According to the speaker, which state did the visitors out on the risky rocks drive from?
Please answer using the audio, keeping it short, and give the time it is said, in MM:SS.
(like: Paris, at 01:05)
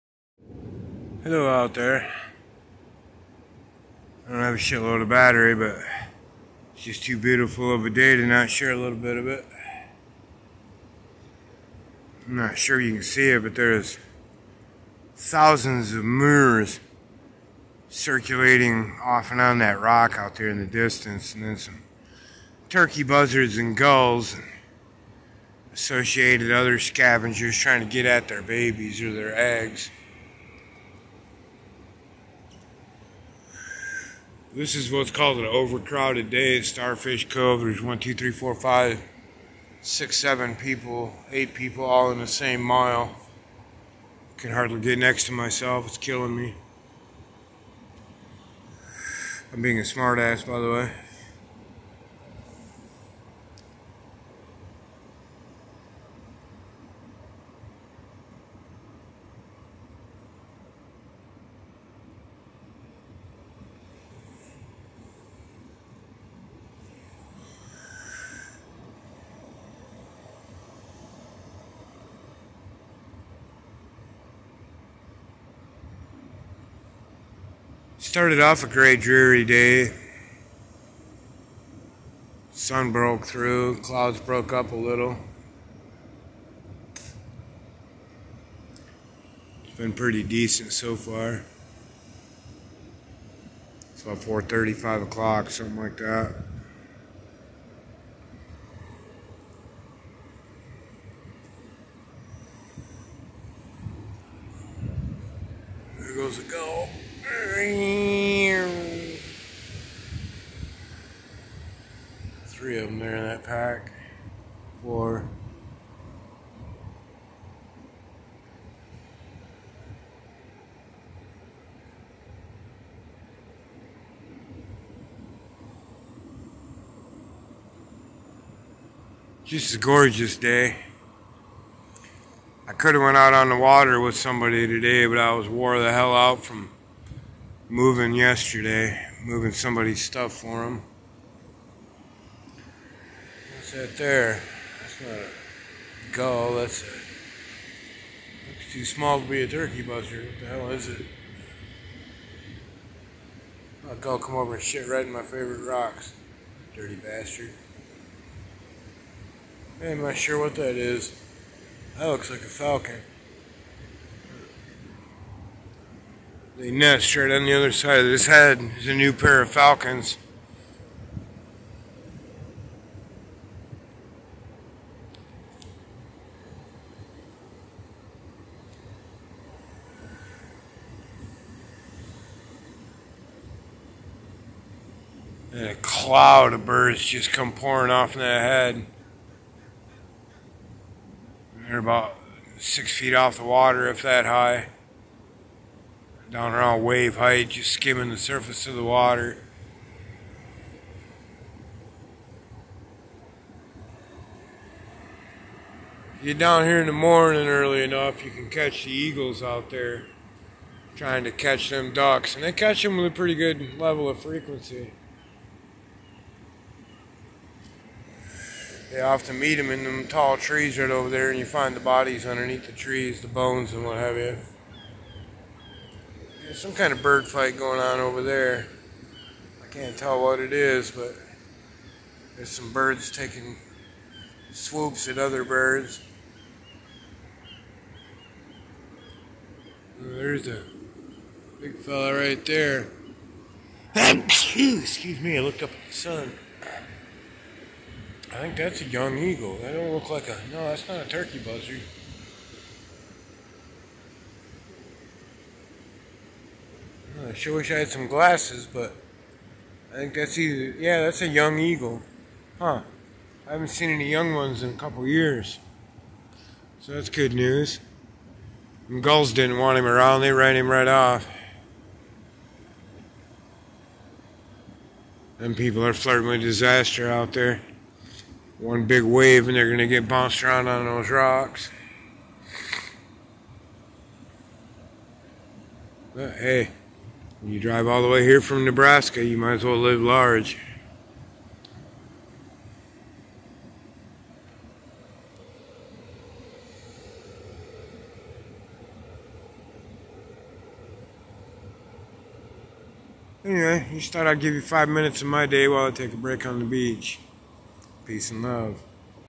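Nebraska, at 04:48.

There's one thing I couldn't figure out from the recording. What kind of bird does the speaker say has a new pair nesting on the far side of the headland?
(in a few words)
falcons.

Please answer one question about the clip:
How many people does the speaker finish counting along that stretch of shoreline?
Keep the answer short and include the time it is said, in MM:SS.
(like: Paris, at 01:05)
8, at 00:41.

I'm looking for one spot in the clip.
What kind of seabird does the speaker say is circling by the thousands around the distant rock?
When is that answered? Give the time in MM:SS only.
00:16.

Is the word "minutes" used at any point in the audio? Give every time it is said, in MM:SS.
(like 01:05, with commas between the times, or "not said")
05:04.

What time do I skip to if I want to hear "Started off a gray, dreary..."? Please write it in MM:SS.
01:18.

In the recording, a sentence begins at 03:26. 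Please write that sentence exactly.
you're down here in the morning early enough, you can catch the eagles out there trying to catch them ducks.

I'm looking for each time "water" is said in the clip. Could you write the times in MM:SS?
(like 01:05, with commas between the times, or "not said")
02:13, 03:13, 03:18.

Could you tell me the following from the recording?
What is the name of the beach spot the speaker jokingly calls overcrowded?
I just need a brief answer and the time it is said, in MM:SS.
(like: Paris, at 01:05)
Starfish Cove, at 00:36.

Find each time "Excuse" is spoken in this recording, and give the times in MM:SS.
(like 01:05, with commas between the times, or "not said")
04:03.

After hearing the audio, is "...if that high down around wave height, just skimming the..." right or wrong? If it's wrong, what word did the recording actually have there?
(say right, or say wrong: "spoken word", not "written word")
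right.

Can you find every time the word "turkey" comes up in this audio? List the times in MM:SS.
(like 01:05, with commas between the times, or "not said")
00:22, 02:29, 04:11.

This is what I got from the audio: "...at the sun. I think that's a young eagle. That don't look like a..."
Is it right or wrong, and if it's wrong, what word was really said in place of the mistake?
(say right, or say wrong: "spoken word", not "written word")
right.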